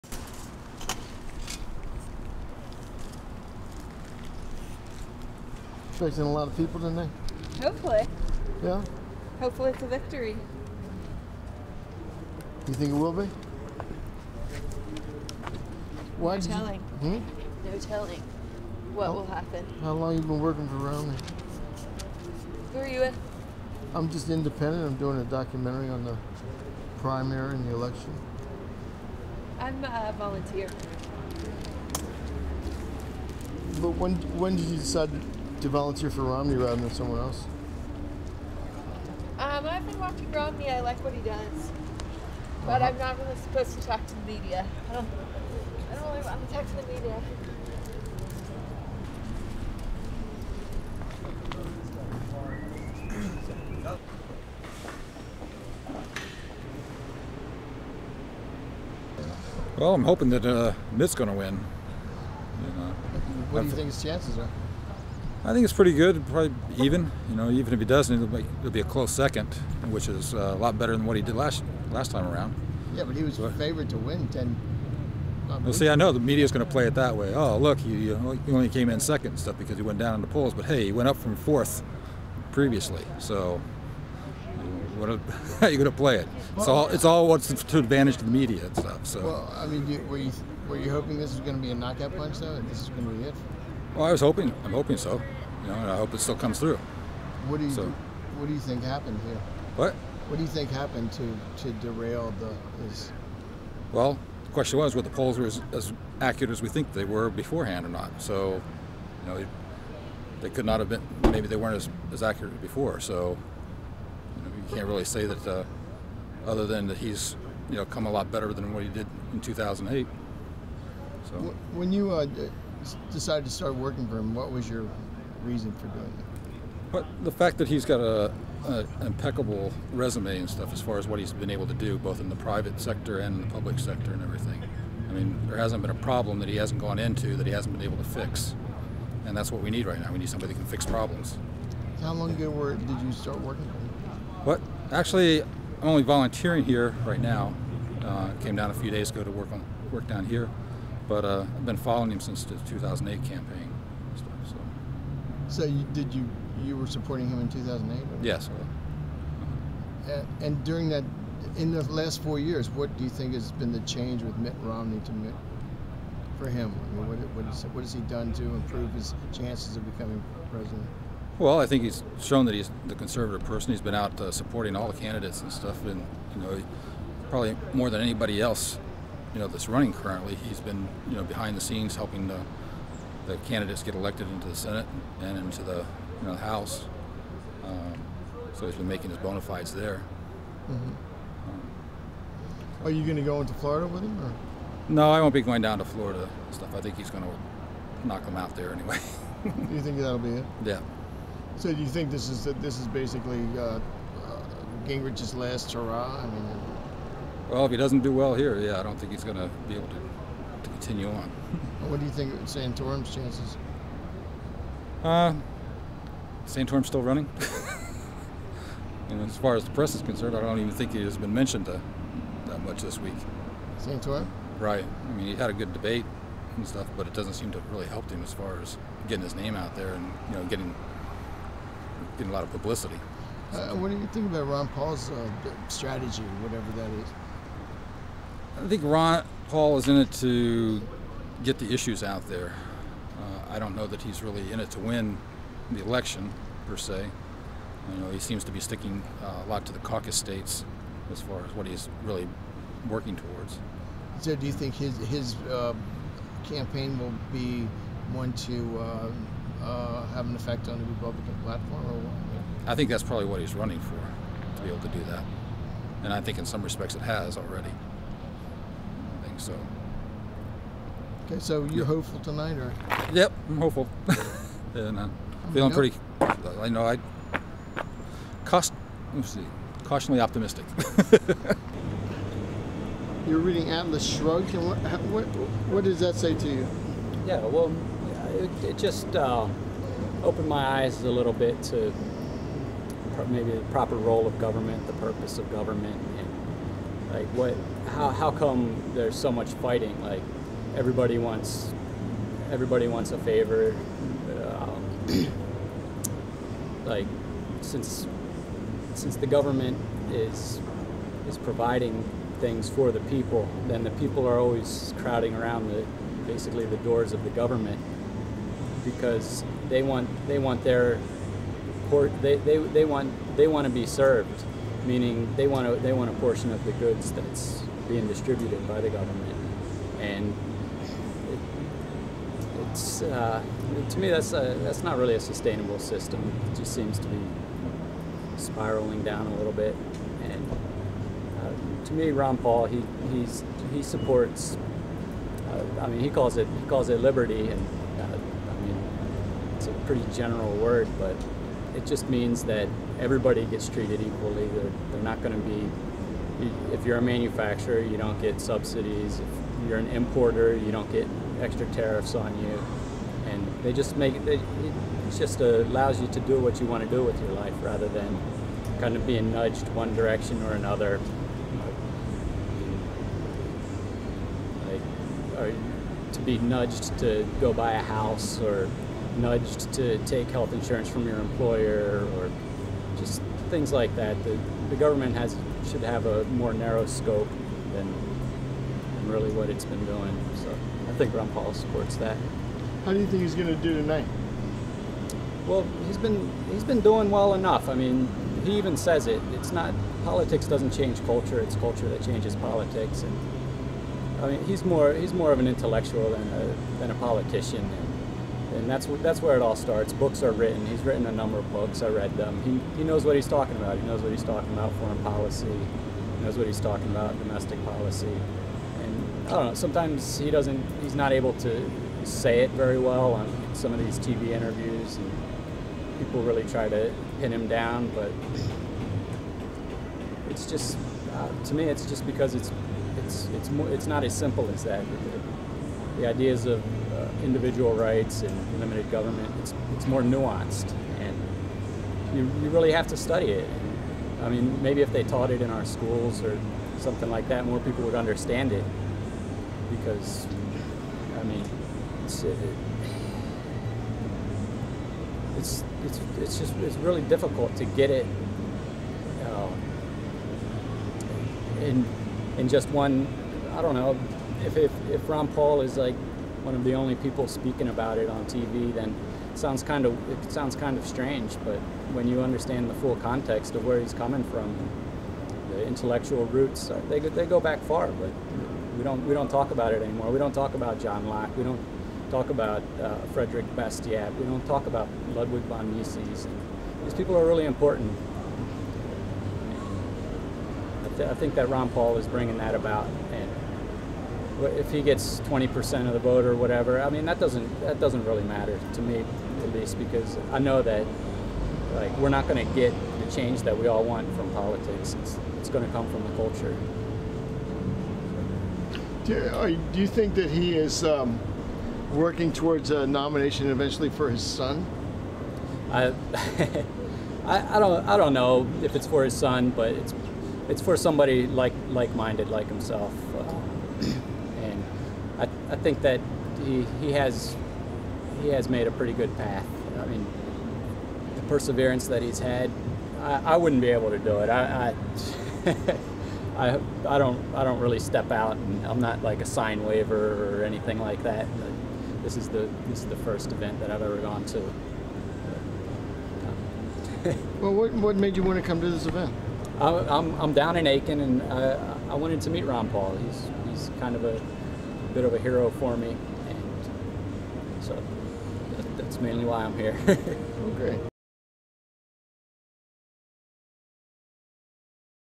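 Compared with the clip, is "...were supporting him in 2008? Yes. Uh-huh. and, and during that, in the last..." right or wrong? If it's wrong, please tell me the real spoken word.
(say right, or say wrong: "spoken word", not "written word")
right.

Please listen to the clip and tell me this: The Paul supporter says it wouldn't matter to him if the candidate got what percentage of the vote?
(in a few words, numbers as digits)
20%.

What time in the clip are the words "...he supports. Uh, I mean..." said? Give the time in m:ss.
5:43.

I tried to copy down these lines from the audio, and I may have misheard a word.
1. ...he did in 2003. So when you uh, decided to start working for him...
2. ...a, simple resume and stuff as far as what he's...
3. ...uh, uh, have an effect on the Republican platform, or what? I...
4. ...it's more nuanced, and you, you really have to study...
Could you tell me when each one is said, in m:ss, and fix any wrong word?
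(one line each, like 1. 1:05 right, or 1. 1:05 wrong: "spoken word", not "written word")
1. 1:58 wrong: "2008", not "2003"
2. 2:08 wrong: "impeccable", not "simple"
3. 4:19 right
4. 7:19 right.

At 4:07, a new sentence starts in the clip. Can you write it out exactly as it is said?
You know, he seems to be sticking uh, a lot to the caucus states as far as what he's really working towards.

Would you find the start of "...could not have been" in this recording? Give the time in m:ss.
1:50.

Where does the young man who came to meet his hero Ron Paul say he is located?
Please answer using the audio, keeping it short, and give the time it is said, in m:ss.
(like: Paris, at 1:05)
Aiken, at 9:10.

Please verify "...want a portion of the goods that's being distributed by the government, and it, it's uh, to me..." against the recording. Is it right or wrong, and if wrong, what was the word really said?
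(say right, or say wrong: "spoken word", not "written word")
right.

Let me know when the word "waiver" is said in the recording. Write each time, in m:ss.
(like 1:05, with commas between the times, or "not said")
8:59.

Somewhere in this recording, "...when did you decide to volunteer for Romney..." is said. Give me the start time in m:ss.
0:34.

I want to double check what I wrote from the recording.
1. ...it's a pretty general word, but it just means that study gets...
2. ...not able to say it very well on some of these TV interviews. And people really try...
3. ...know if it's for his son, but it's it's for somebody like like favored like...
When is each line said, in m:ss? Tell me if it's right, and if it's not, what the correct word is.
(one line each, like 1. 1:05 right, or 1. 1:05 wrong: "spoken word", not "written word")
1. 5:49 wrong: "everybody", not "study"
2. 7:00 right
3. 8:38 wrong: "minded", not "favored".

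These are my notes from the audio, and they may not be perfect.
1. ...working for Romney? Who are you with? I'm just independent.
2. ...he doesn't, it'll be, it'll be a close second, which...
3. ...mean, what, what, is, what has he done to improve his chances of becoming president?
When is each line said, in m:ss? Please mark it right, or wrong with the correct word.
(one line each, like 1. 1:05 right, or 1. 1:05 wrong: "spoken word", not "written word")
1. 0:20 right
2. 1:07 right
3. 2:46 right.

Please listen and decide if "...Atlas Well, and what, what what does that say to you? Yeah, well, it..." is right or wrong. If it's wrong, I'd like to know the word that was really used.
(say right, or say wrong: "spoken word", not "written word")
wrong: "Shrugged", not "Well".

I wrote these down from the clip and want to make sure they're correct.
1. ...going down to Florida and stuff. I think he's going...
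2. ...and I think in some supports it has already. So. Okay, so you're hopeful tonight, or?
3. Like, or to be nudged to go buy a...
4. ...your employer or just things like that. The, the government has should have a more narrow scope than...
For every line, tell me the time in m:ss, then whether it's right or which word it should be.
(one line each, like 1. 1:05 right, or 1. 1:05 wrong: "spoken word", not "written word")
1. 3:15 right
2. 4:26 wrong: "respects", not "supports"
3. 6:14 right
4. 6:21 right.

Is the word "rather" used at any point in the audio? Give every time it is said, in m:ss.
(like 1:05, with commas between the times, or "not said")
0:36, 6:07.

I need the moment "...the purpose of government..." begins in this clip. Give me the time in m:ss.
4:54.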